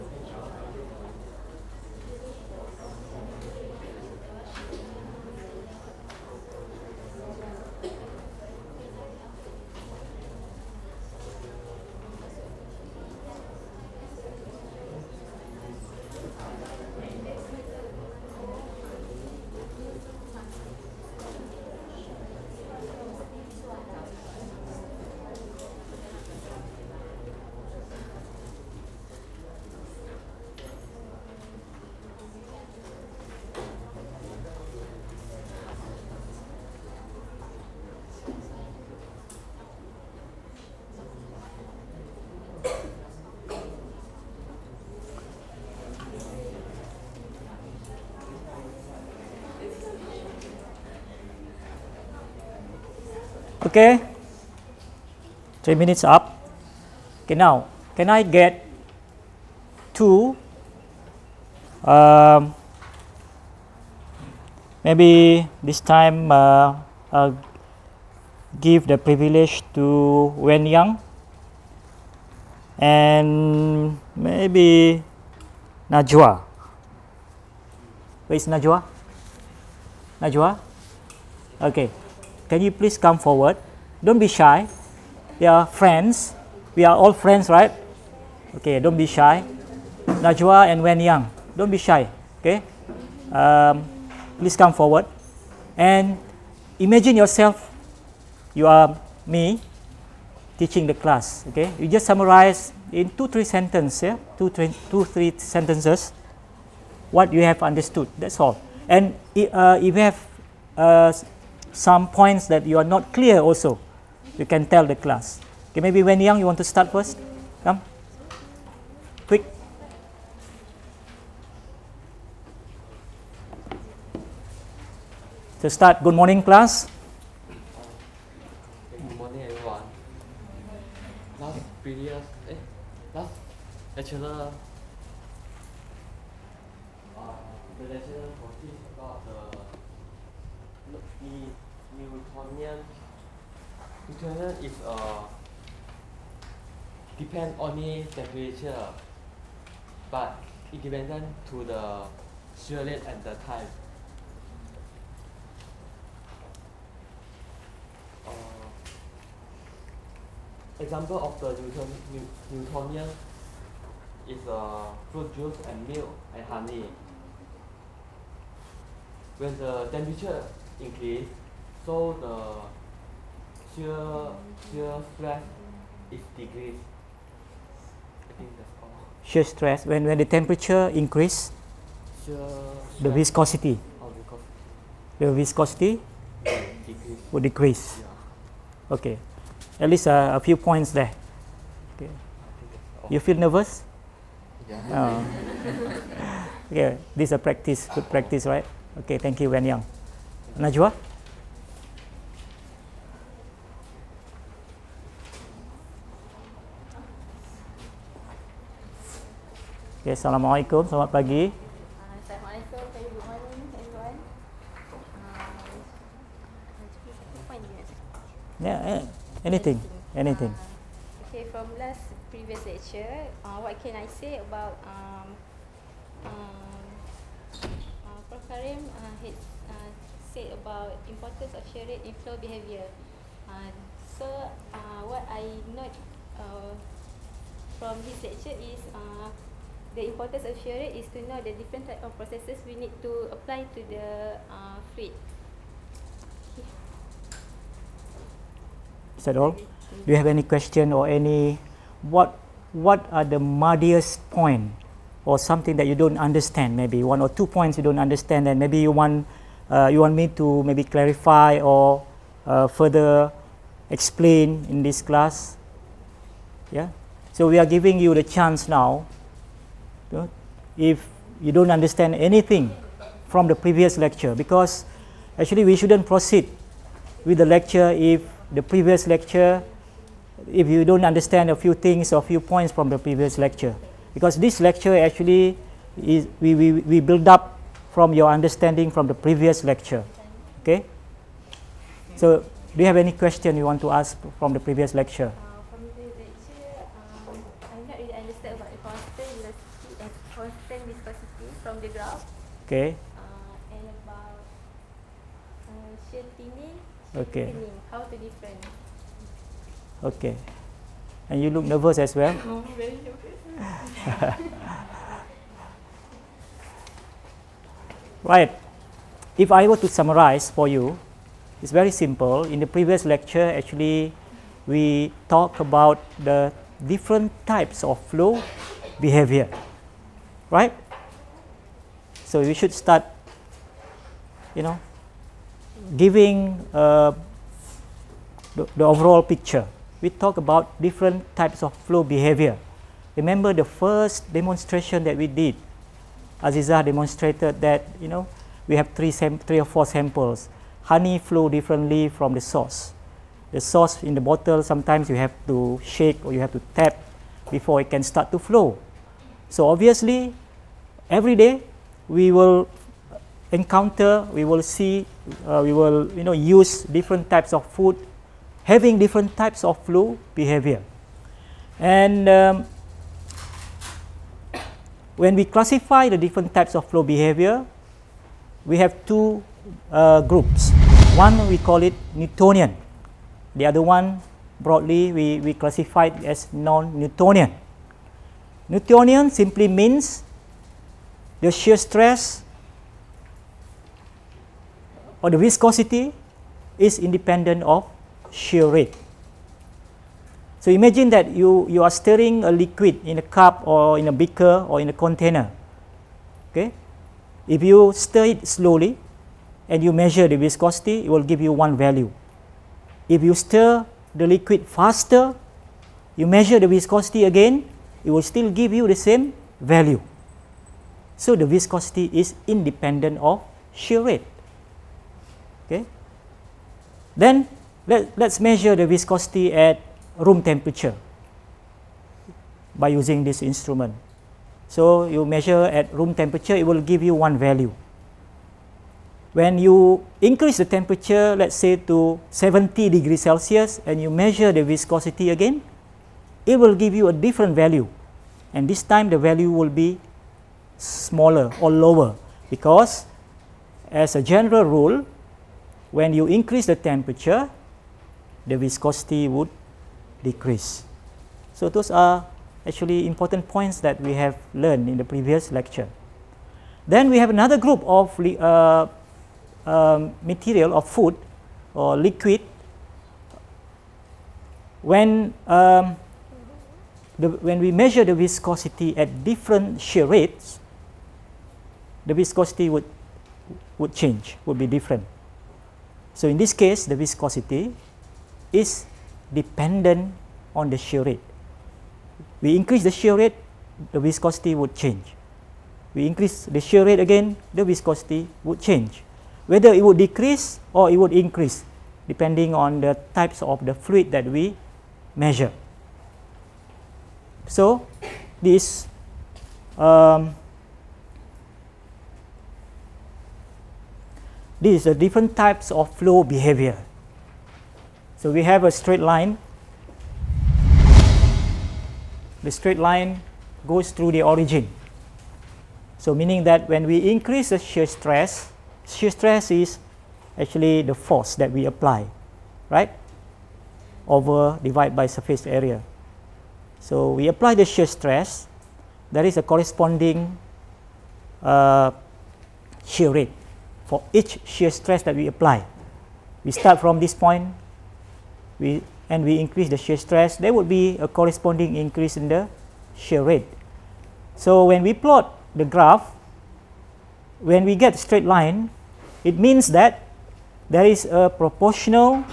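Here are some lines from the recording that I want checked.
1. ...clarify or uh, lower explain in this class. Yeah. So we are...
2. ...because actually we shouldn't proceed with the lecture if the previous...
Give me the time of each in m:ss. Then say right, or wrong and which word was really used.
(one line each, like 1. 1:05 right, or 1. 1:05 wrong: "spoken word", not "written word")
1. 4:20 wrong: "further", not "lower"
2. 4:34 right.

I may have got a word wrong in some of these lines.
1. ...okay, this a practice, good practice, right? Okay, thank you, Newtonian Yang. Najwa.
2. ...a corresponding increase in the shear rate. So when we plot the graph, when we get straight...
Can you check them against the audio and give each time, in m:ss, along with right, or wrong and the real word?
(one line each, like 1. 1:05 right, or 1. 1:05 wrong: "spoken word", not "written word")
1. 3:16 wrong: "Wen", not "Newtonian"
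2. 9:11 right.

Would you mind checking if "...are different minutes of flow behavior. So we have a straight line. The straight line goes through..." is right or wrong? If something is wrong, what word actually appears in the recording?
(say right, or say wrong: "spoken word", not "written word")
wrong: "types", not "minutes".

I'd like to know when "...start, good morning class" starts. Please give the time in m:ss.
2:05.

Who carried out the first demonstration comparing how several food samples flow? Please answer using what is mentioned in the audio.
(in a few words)
Aziza.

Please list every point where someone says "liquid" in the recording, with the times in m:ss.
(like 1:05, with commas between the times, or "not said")
6:42, 6:54, 7:51.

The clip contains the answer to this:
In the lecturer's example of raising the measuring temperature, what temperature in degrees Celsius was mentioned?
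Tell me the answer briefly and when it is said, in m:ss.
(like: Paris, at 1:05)
70, at 7:22.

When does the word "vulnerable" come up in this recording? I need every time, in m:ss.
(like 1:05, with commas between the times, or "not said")
not said.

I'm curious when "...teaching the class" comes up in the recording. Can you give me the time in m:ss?
1:40.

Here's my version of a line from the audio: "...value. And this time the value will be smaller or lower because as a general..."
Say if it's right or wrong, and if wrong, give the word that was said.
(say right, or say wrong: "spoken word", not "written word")
right.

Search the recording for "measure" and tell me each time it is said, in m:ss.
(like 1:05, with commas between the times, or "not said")
6:49, 6:56, 7:08, 7:15, 7:24, 7:57, 8:25.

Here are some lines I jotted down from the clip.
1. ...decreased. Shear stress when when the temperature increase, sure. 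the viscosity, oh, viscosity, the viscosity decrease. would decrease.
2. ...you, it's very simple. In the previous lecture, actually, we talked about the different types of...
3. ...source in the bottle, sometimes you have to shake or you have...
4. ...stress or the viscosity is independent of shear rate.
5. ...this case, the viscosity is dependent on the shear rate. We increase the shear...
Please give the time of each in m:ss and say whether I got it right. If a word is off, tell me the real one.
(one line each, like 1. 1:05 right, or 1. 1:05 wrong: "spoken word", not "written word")
1. 2:56 right
2. 5:20 right
3. 5:53 right
4. 6:31 right
5. 8:06 right.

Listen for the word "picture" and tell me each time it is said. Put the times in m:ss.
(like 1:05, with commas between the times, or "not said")
5:39.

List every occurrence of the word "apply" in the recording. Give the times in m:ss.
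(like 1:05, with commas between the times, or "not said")
4:03, 8:51, 8:57, 9:05.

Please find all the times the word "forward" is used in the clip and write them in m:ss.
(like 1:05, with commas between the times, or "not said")
1:23, 1:34.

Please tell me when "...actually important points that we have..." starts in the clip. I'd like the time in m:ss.
7:42.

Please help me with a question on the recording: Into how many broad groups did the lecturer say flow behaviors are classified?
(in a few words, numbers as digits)
2.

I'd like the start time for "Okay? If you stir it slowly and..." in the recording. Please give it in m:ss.
6:46.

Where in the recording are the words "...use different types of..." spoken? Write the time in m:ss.
6:06.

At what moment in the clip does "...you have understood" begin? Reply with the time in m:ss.
1:47.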